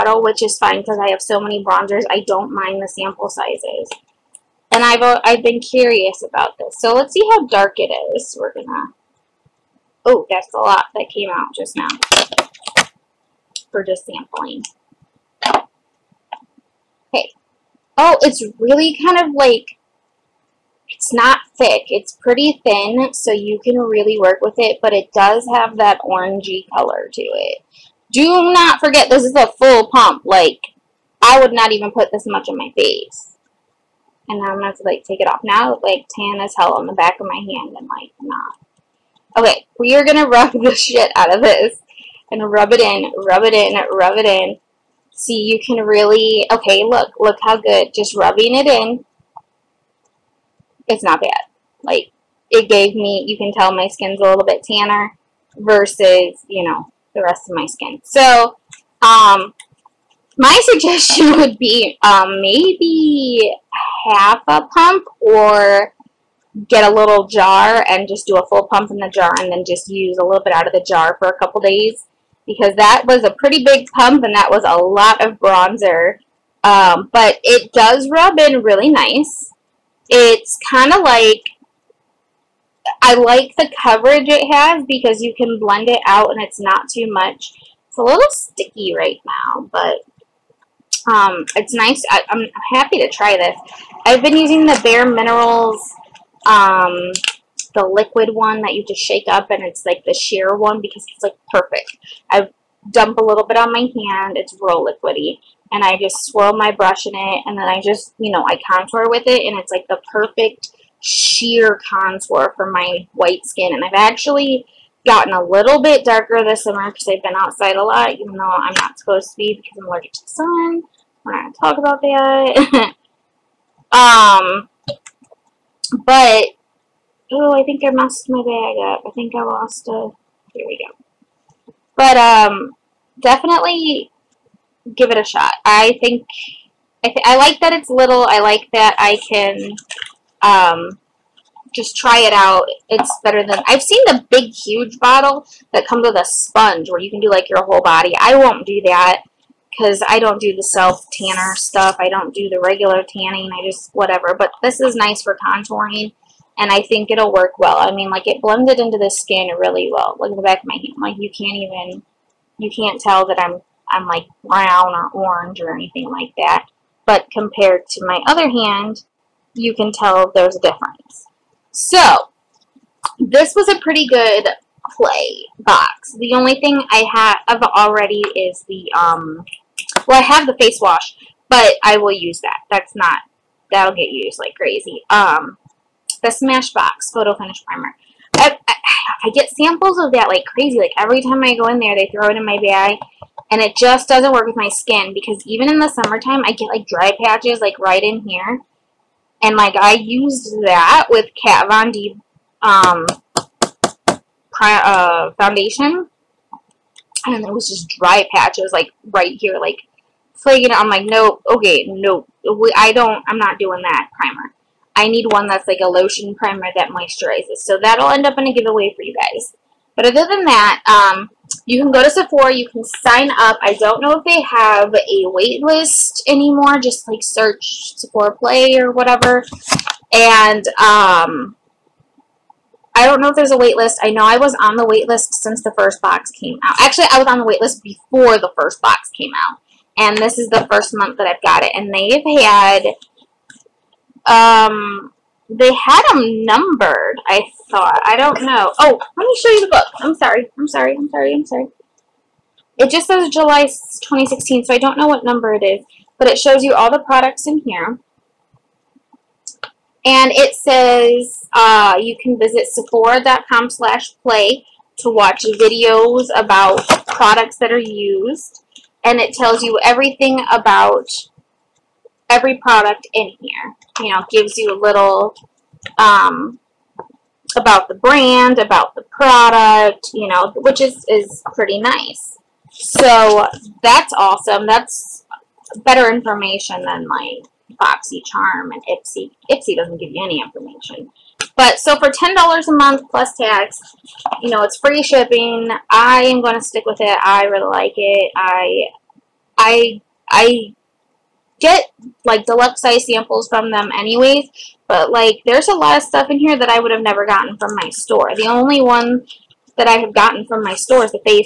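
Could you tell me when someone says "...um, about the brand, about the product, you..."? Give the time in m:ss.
4:35.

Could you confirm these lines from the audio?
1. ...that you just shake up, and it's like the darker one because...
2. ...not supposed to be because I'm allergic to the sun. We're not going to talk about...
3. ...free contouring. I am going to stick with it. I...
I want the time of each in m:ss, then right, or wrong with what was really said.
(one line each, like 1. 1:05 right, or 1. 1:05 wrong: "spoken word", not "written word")
1. 1:38 wrong: "sheer", not "darker"
2. 1:58 right
3. 4:54 wrong: "shipping", not "contouring".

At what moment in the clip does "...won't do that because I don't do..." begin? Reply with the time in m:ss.
2:28.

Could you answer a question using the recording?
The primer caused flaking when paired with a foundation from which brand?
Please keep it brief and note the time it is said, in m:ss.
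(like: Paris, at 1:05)
Kat Von D, at 3:21.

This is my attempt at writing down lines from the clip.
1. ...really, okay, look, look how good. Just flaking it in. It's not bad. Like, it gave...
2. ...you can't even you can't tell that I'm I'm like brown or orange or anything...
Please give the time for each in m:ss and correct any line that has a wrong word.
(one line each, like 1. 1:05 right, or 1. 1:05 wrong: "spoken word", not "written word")
1. 0:45 wrong: "rubbing", not "flaking"
2. 2:41 right.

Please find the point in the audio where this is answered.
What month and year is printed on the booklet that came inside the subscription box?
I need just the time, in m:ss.
4:13.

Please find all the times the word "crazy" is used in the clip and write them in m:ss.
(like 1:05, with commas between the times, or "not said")
3:04, 3:10.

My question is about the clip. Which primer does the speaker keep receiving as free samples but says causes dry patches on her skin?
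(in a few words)
Smashbox Photo Finish Primer.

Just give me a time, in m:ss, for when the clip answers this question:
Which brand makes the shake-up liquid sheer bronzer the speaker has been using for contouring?
1:34.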